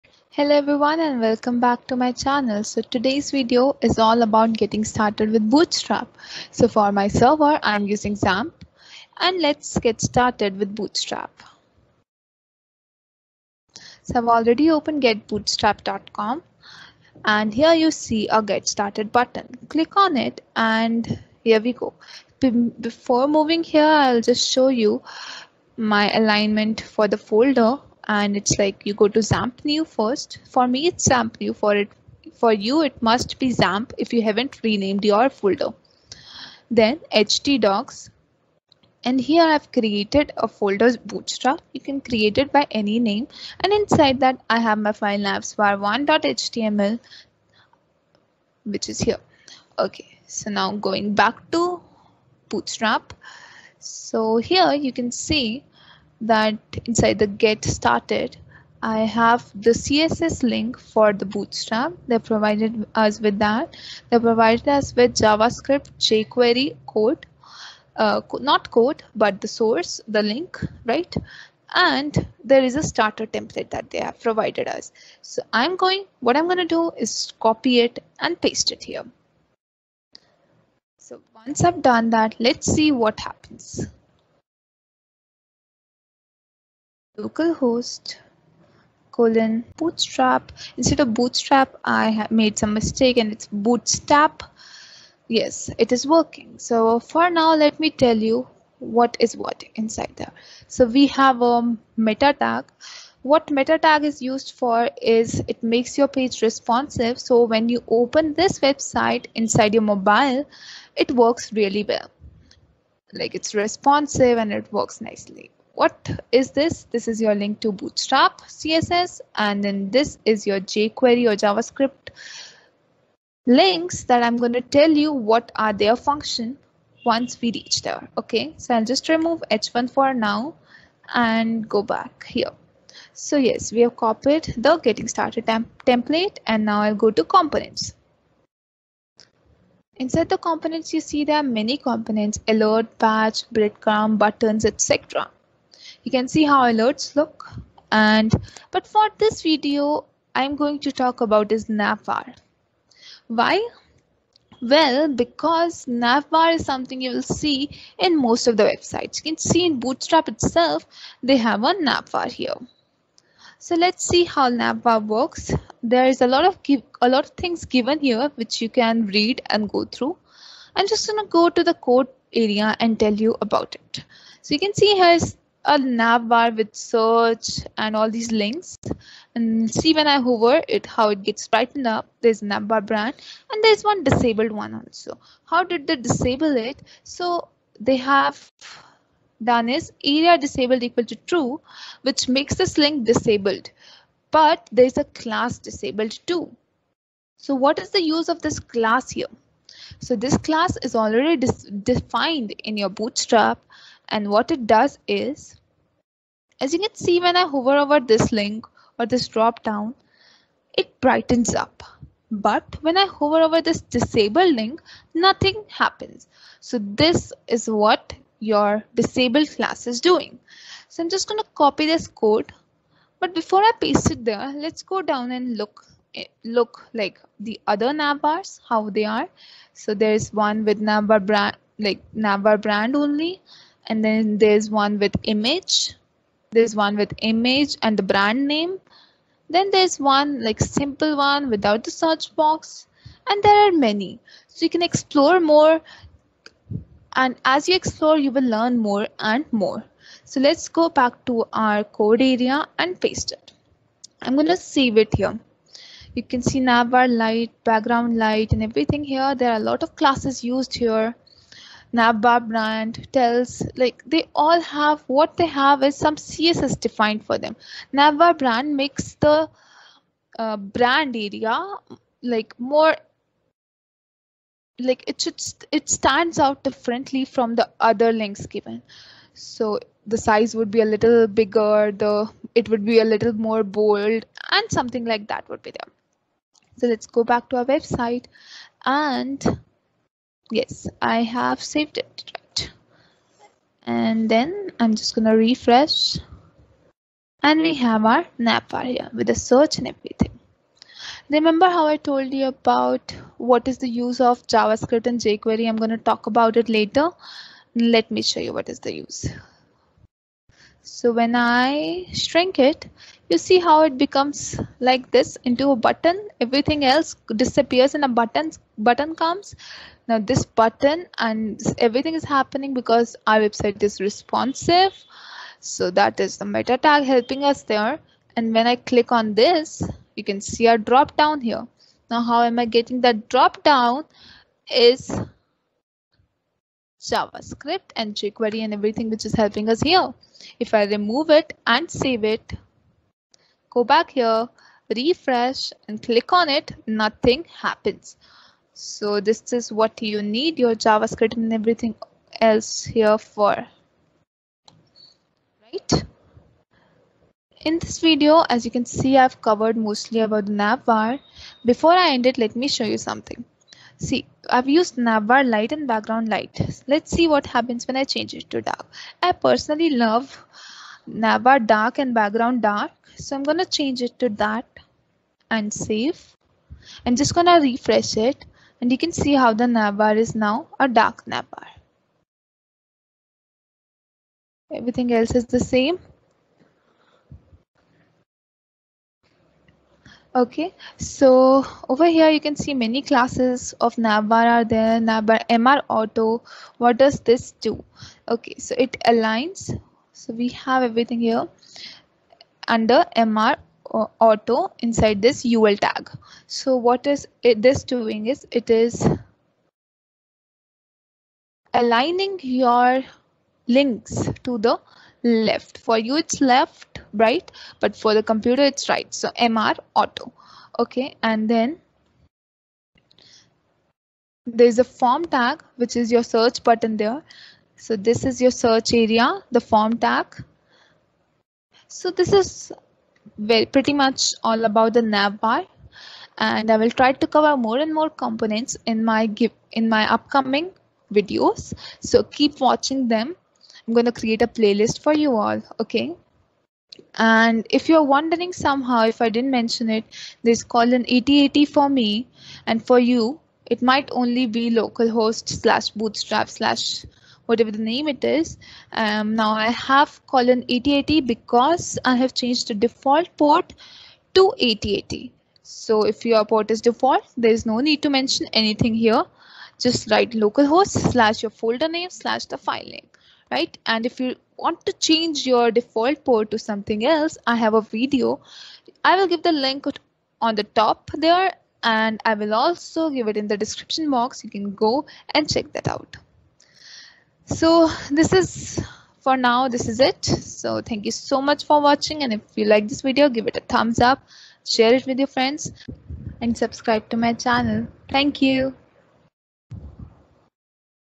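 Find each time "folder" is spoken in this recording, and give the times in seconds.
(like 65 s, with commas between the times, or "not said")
27 s, 35 s, 40 s, 471 s.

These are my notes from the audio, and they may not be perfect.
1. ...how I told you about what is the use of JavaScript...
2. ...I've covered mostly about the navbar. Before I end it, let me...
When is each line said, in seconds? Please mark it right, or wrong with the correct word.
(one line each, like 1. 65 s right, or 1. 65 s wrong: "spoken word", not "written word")
1. 301 s right
2. 359 s right.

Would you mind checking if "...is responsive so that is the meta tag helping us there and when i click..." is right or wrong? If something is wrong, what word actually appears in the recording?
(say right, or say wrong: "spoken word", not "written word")
right.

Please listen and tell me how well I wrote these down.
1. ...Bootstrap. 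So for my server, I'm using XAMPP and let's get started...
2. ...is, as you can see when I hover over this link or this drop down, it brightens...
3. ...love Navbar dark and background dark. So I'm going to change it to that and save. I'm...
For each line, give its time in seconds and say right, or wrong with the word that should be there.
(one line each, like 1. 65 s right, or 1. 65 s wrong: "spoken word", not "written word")
1. 5 s right
2. 205 s right
3. 369 s right.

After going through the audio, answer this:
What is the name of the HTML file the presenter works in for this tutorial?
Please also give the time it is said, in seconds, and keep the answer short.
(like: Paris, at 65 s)
navsvar1.html, at 45 s.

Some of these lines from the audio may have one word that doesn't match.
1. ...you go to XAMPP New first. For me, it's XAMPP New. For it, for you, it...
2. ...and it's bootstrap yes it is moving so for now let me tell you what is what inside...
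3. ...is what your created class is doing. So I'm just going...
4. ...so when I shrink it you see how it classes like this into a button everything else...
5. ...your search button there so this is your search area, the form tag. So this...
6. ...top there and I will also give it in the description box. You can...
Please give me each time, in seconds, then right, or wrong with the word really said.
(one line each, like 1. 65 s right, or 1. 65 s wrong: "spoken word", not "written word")
1. 28 s right
2. 93 s wrong: "working", not "moving"
3. 217 s wrong: "disabled", not "created"
4. 310 s wrong: "becomes", not "classes"
5. 426 s right
6. 480 s right.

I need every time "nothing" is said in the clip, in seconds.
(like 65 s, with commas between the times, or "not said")
215 s, 346 s.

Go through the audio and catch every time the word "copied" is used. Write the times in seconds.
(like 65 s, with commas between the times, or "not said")
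133 s.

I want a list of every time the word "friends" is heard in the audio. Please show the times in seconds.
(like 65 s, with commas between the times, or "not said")
495 s.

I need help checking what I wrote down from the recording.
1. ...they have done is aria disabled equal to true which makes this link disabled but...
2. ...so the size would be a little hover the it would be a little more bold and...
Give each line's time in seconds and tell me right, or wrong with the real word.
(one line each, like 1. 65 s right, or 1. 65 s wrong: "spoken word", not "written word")
1. 187 s right
2. 279 s wrong: "bigger", not "hover".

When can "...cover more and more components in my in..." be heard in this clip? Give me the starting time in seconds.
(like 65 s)
437 s.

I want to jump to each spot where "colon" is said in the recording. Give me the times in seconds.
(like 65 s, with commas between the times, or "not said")
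89 s, 460 s.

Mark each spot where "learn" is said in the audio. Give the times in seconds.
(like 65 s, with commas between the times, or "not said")
248 s.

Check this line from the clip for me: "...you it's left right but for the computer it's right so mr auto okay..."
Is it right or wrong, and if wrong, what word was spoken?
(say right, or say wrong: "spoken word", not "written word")
right.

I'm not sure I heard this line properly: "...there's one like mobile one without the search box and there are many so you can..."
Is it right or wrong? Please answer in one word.
wrong.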